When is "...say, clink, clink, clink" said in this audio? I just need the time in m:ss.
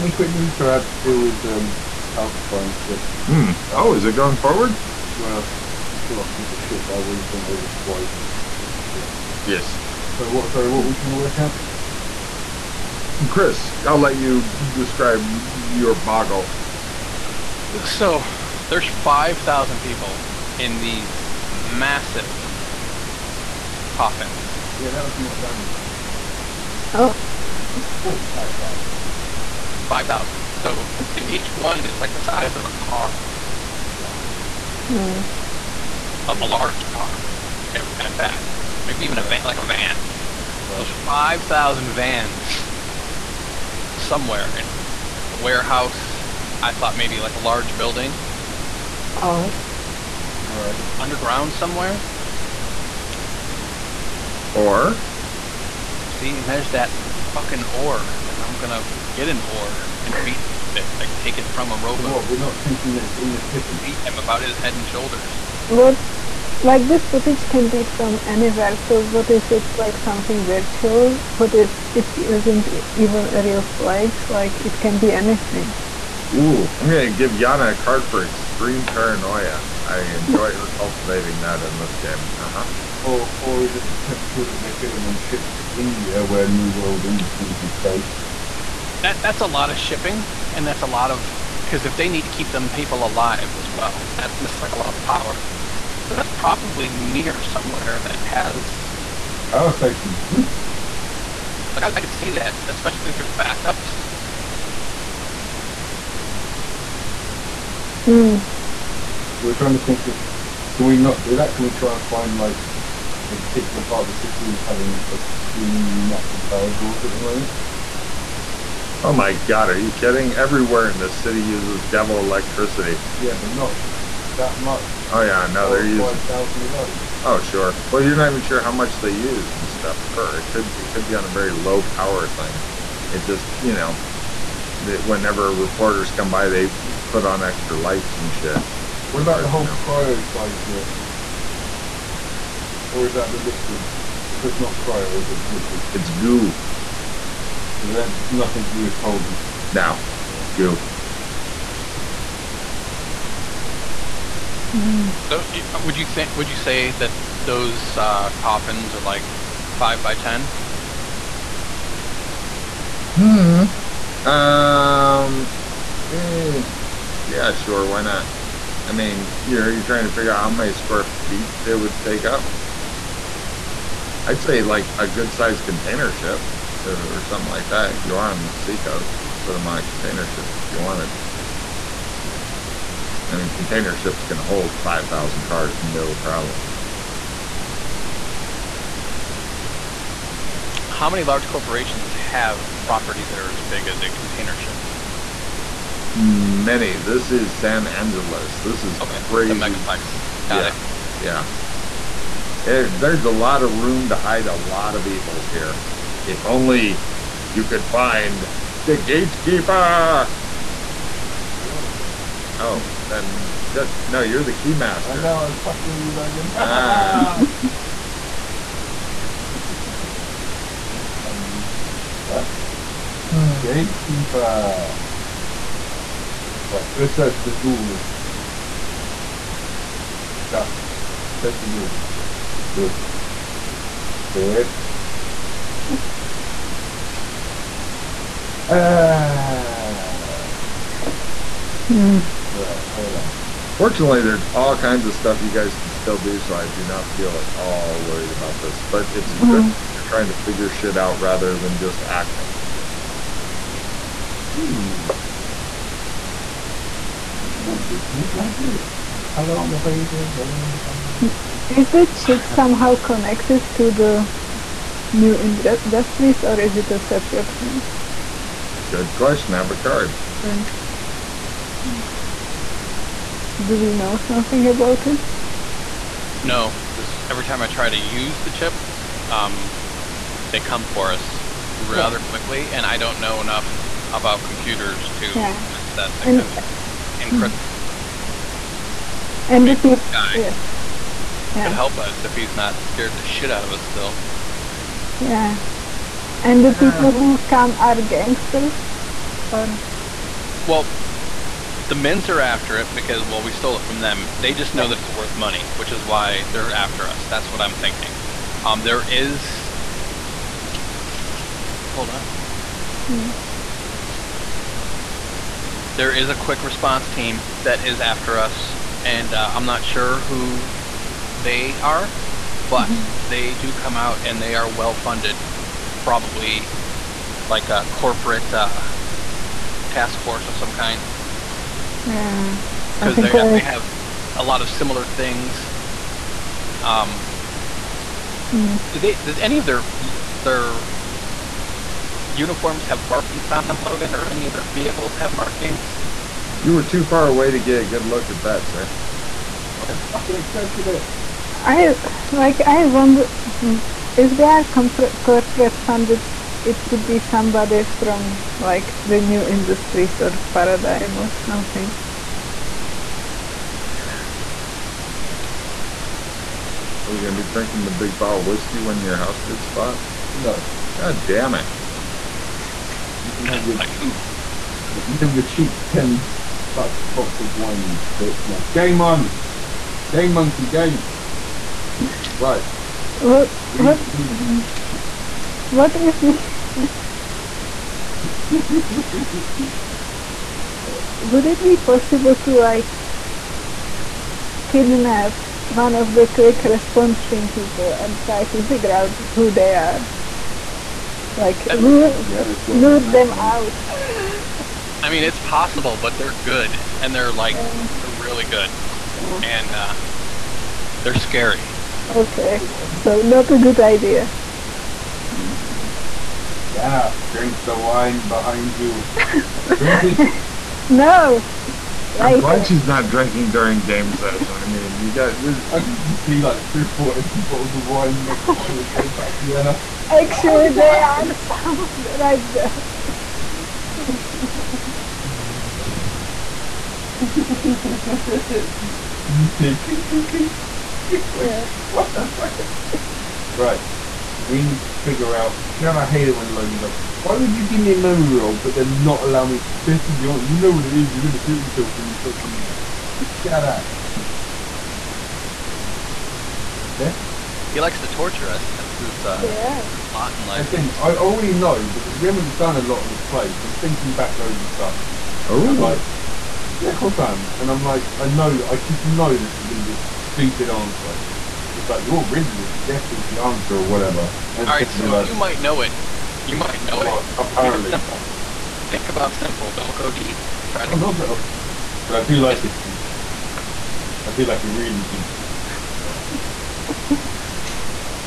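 7:19.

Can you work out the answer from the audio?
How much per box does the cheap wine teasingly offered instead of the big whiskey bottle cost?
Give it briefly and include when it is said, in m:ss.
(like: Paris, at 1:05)
$10, at 6:15.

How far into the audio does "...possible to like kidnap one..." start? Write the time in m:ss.
6:31.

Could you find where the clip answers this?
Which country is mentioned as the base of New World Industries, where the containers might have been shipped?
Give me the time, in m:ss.
1:25.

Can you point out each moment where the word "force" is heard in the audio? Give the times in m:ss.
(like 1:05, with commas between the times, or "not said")
5:30.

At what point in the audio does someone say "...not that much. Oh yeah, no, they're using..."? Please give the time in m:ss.
2:03.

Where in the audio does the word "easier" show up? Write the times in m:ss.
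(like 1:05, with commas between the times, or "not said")
not said.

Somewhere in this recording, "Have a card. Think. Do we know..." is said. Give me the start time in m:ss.
4:29.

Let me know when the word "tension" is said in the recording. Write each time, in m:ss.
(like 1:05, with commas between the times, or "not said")
not said.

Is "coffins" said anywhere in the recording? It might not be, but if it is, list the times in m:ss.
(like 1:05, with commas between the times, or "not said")
0:23, 2:38.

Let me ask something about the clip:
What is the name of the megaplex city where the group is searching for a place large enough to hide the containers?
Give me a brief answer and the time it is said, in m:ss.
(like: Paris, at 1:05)
San Angeles, at 3:17.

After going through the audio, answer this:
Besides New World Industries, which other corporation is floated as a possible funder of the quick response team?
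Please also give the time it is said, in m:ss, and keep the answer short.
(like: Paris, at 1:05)
Paradigm, at 6:00.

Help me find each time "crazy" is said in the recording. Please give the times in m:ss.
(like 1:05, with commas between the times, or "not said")
3:19.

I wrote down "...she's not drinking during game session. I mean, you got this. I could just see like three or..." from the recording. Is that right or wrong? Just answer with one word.
right.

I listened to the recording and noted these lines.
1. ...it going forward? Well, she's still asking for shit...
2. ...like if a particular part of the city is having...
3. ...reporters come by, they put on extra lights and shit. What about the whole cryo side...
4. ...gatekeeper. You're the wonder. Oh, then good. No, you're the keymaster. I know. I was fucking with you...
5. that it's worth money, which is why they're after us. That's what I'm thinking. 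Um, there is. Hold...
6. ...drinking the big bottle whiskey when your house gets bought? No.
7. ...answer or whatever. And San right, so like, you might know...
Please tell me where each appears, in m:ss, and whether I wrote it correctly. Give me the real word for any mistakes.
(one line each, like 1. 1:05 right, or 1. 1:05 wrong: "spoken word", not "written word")
1. 0:04 right
2. 1:52 right
3. 2:15 right
4. 3:28 wrong: "gatekeeper", not "wonder"
5. 5:04 right
6. 6:07 right
7. 7:53 wrong: "All", not "San".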